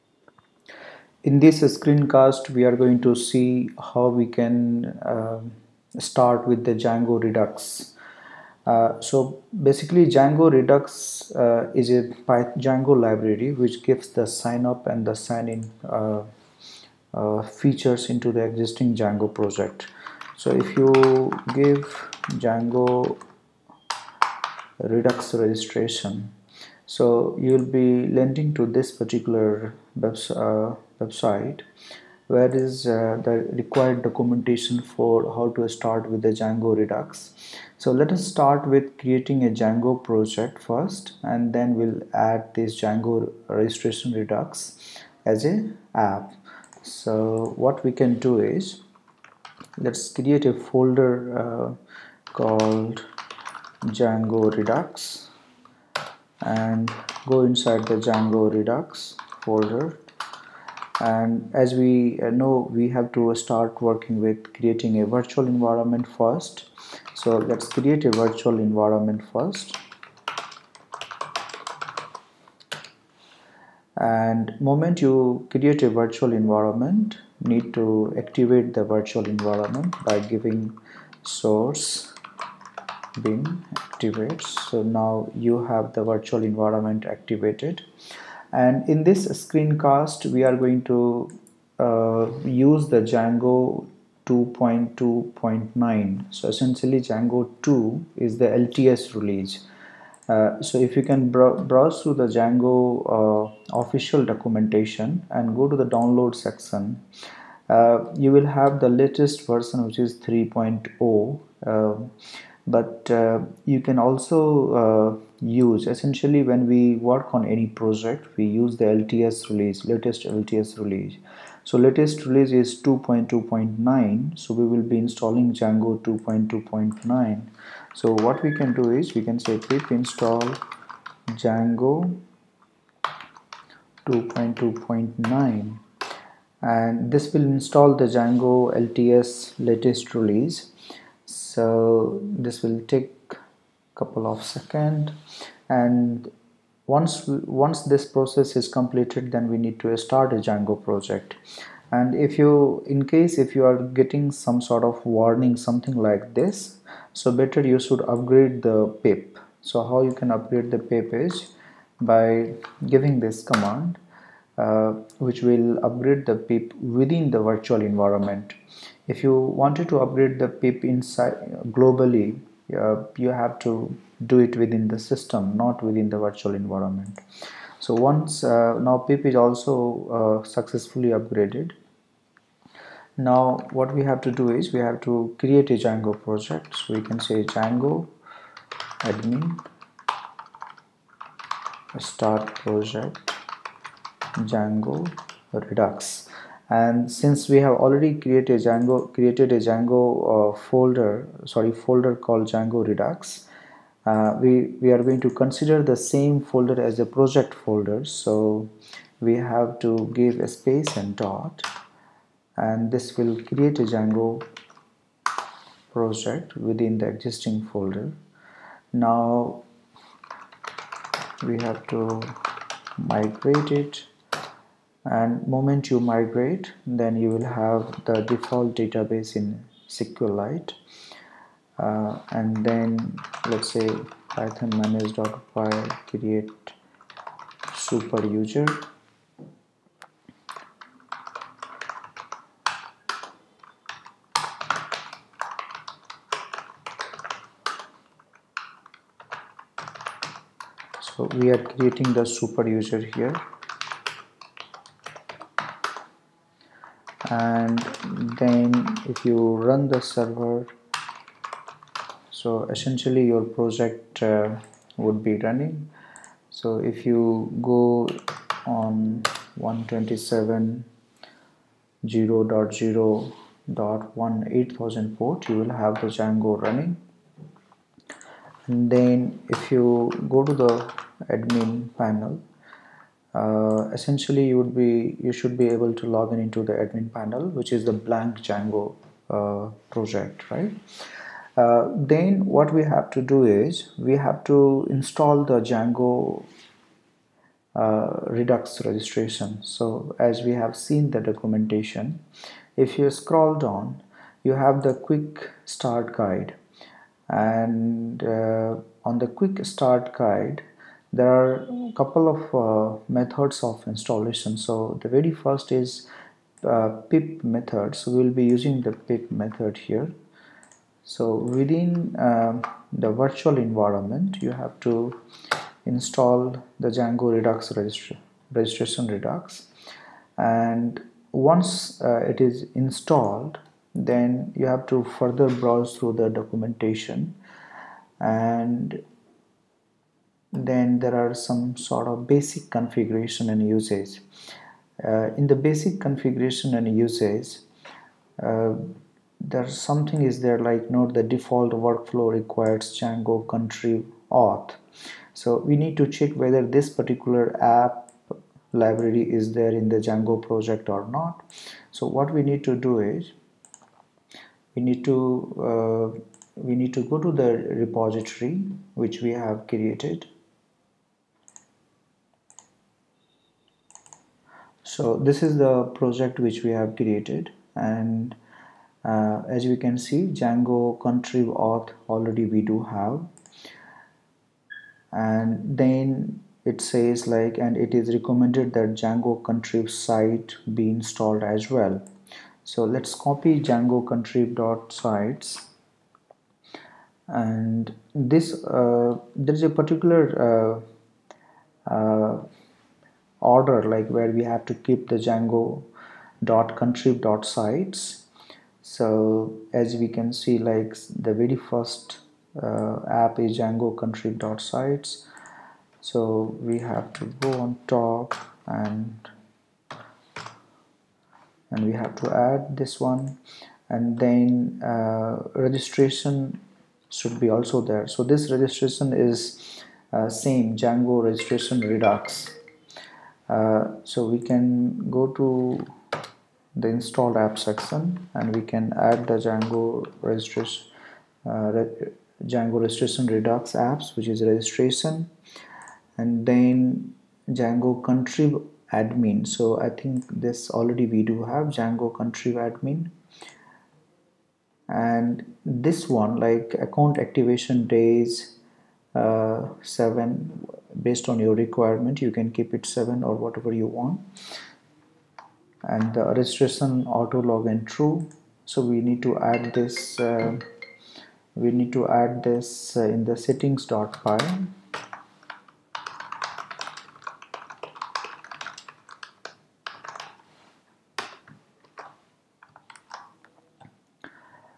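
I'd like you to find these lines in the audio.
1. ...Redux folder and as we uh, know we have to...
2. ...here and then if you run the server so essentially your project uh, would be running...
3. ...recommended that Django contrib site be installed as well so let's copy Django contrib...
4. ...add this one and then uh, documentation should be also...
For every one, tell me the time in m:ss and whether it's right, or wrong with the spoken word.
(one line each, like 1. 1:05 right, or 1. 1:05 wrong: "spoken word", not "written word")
1. 0:58 right
2. 4:13 right
3. 6:28 right
4. 7:02 wrong: "registration", not "documentation".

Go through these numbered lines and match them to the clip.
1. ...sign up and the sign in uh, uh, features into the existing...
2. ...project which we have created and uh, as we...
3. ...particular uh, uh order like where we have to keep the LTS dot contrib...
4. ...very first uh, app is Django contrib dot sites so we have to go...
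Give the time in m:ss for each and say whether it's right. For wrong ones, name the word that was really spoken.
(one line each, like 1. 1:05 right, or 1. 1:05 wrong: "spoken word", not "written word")
1. 0:14 right
2. 6:15 right
3. 6:39 wrong: "Django", not "LTS"
4. 6:51 right.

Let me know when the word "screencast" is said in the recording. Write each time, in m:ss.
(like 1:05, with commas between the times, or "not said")
0:01, 1:29.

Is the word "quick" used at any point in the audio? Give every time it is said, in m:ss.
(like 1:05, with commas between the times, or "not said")
5:04, 5:09.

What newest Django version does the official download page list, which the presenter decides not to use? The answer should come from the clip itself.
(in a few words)
3.0.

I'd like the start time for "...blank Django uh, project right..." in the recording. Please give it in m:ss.
4:47.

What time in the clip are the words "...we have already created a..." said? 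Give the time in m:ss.
3:17.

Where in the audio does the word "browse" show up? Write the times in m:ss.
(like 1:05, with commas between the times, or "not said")
1:41, 5:35.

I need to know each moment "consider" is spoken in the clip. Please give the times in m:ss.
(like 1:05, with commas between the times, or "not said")
3:25.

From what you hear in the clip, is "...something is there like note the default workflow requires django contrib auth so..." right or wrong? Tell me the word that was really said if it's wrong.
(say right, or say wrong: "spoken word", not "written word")
right.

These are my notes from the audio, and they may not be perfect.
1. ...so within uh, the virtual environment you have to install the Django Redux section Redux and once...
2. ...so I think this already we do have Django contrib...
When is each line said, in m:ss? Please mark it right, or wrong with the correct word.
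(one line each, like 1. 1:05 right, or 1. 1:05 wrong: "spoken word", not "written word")
1. 5:21 wrong: "registration", not "section"
2. 7:29 right.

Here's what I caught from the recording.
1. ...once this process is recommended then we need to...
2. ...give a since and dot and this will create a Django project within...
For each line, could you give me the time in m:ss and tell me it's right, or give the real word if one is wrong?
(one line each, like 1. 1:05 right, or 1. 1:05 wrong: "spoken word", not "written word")
1. 2:27 wrong: "completed", not "recommended"
2. 3:30 wrong: "space", not "since".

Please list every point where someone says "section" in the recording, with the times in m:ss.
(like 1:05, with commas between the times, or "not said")
1:46, 7:17.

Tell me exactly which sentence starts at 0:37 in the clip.
So let us start with creating a Django project first and then we'll add this Django registration Redux as a app.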